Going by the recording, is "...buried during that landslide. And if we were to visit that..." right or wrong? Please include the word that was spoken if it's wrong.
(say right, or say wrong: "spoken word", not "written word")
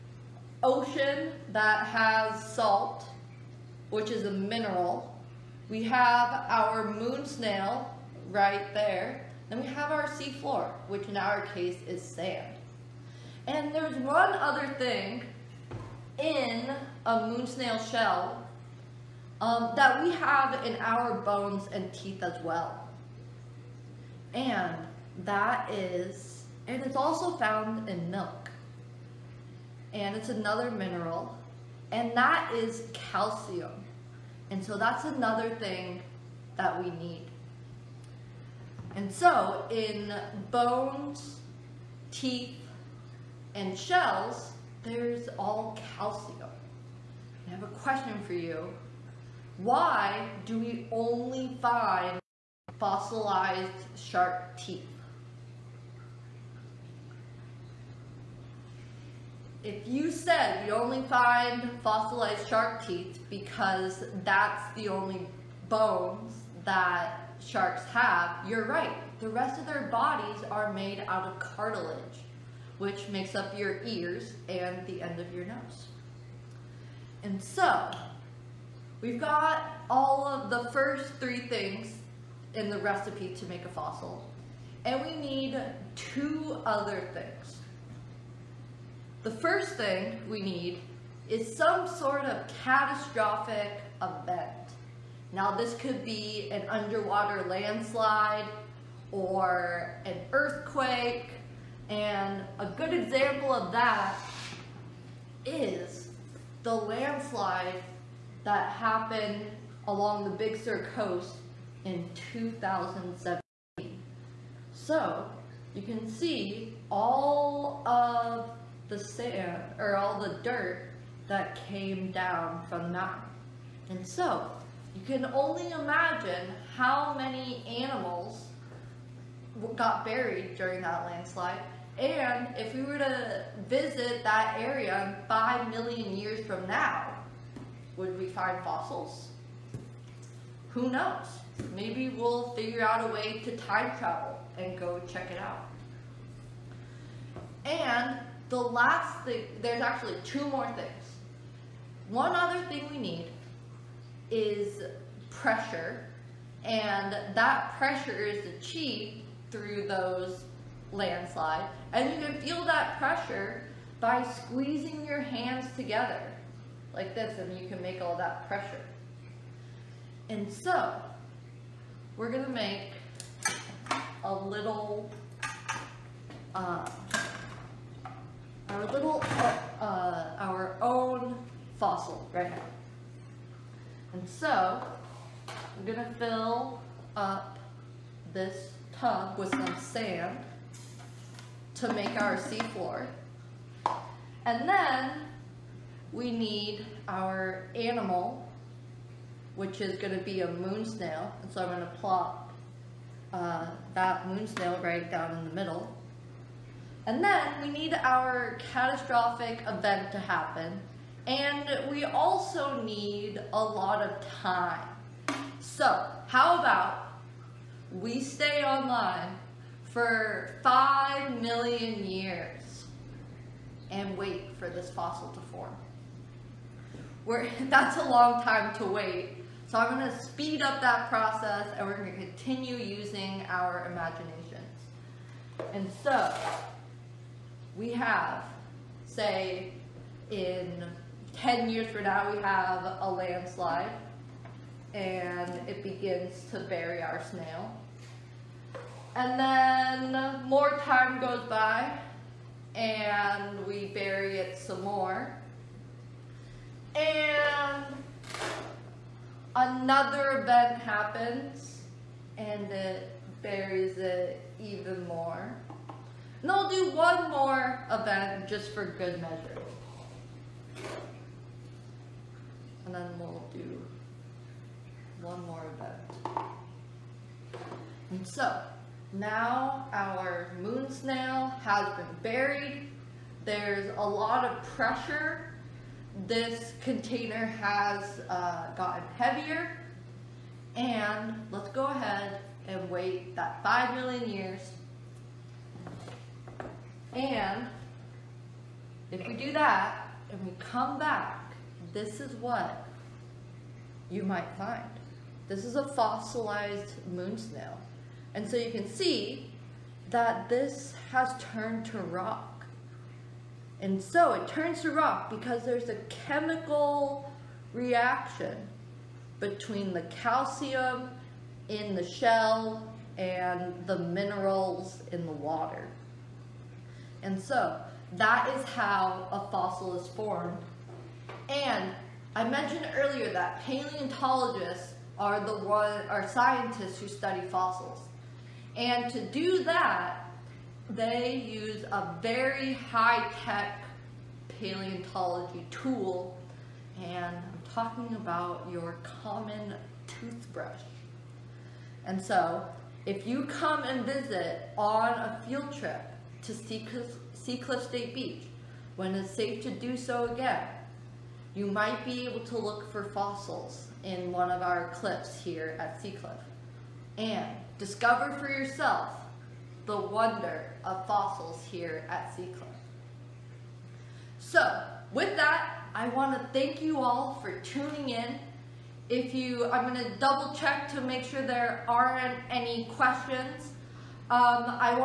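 right.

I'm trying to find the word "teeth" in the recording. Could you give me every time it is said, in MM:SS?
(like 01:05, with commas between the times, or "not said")
00:21, 00:42, 00:54, 01:02.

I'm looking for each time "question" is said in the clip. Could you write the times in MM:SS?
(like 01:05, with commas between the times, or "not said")
00:47, 06:22.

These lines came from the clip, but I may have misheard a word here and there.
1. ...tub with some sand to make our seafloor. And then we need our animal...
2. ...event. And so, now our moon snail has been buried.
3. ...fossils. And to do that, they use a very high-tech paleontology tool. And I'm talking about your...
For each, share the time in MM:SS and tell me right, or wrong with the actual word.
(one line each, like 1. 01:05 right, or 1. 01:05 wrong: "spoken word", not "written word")
1. 03:08 right
2. 04:35 right
3. 05:37 right.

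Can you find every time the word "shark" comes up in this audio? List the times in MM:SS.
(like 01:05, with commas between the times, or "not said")
00:53, 01:02, 01:07.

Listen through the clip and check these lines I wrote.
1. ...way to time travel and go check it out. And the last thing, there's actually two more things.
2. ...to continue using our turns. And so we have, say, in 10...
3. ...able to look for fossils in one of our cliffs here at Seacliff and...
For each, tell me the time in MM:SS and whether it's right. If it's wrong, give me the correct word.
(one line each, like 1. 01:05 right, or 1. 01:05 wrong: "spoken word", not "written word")
1. 02:23 right
2. 03:52 wrong: "imaginations", not "turns"
3. 06:02 right.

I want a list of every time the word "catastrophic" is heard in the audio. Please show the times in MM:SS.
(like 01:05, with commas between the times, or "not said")
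01:32, 03:28.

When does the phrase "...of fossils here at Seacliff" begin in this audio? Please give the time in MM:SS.
06:10.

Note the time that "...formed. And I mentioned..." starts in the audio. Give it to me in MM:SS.
05:30.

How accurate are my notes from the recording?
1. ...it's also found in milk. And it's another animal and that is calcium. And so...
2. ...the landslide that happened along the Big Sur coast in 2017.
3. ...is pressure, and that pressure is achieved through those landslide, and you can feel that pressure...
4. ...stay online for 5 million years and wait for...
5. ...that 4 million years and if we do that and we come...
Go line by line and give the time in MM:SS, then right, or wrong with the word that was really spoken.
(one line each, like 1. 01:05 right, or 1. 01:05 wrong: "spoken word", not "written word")
1. 00:26 wrong: "mineral", not "animal"
2. 01:46 right
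3. 02:34 right
4. 03:38 right
5. 04:53 wrong: "5", not "4".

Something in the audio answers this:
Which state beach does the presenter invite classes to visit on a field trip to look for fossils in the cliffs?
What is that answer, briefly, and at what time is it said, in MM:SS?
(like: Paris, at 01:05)
Seacliff State Beach, at 05:56.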